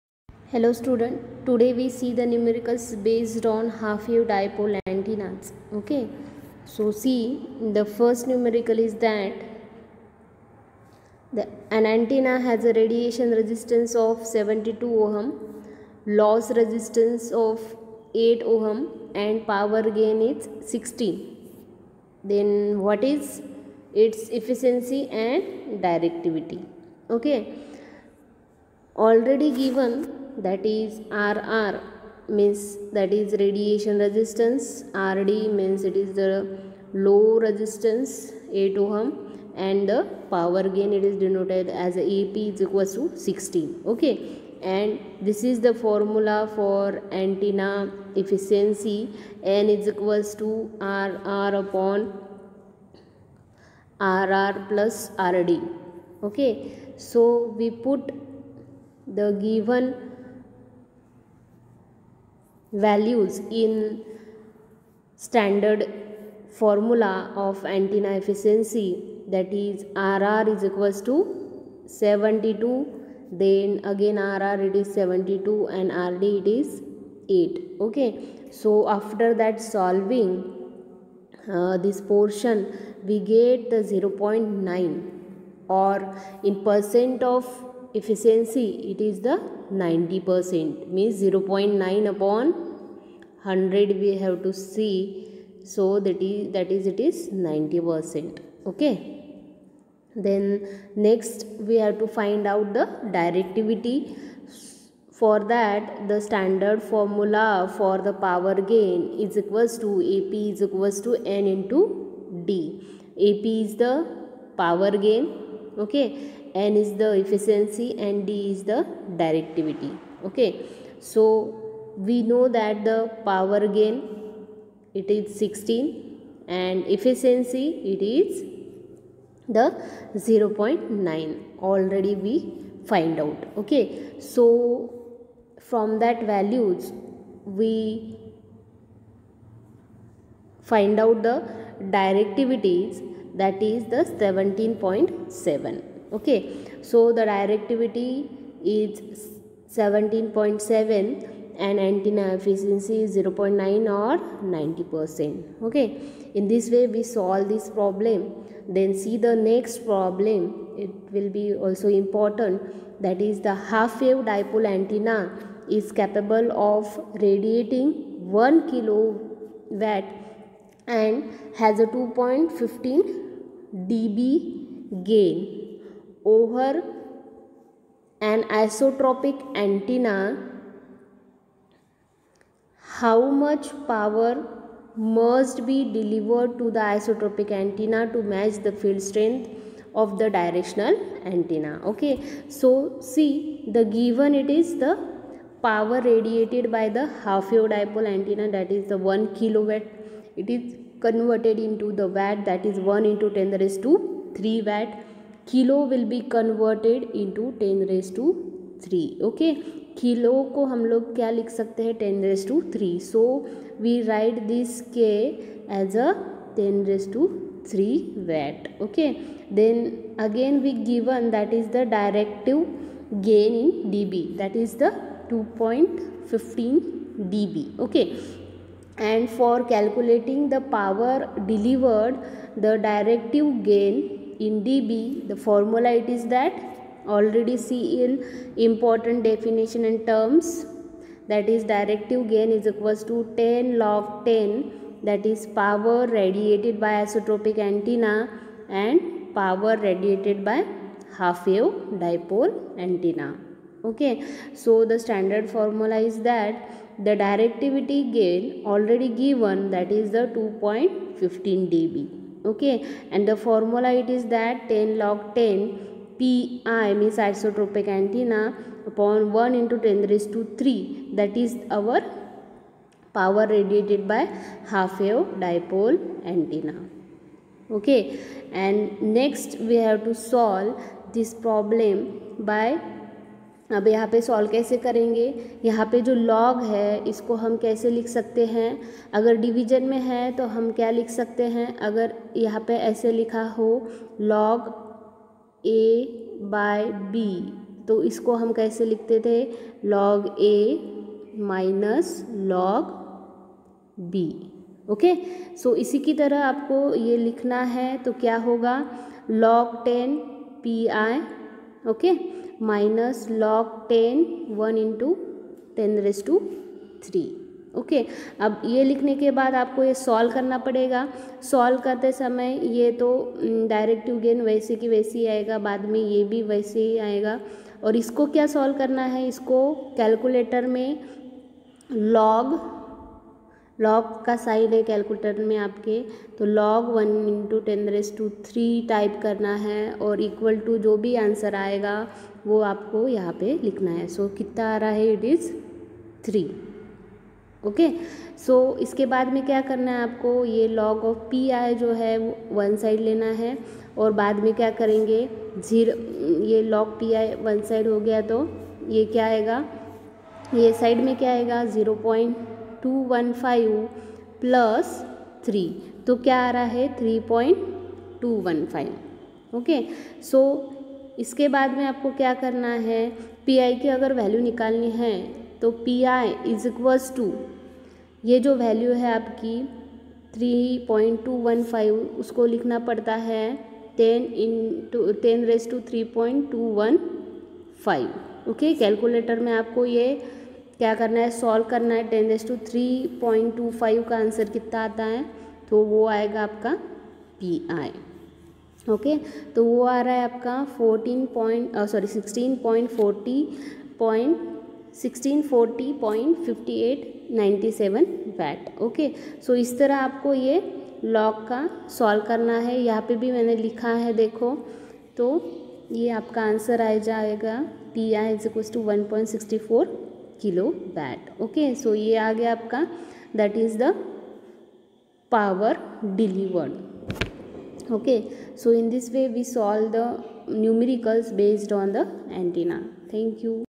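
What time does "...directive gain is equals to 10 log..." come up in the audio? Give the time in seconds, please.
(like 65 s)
241 s.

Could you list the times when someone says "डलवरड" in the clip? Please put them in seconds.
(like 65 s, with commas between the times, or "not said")
231 s, 426 s.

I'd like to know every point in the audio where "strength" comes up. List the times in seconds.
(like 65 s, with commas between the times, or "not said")
189 s.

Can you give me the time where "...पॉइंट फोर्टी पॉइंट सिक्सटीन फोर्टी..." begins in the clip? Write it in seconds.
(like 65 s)
402 s.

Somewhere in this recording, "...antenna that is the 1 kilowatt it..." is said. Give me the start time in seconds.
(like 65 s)
198 s.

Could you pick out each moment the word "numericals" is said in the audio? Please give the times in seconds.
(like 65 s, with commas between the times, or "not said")
2 s, 8 s.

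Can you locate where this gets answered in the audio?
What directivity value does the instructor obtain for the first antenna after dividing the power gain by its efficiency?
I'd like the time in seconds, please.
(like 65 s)
143 s.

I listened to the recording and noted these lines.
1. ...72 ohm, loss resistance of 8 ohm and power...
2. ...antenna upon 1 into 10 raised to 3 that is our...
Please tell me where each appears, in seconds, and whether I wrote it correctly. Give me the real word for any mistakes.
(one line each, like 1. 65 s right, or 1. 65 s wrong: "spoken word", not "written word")
1. 14 s right
2. 267 s right.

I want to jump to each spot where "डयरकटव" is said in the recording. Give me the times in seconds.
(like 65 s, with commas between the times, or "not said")
221 s, 232 s, 323 s.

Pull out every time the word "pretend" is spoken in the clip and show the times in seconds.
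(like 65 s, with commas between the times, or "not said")
not said.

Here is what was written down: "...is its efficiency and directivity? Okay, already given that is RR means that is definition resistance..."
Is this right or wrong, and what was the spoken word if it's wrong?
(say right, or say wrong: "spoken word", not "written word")
wrong: "radiation", not "definition".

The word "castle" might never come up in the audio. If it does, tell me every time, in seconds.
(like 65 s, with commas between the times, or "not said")
not said.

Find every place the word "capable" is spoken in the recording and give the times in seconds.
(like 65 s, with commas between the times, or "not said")
166 s.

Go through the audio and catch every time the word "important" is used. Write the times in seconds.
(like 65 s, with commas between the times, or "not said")
161 s, 238 s.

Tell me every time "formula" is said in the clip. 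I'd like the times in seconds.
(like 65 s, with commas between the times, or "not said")
45 s, 66 s, 106 s, 235 s, 255 s, 263 s.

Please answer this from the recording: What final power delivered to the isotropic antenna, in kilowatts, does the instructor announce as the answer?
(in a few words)
1.64 kilowatt.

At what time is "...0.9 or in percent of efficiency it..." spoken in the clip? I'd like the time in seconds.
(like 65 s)
83 s.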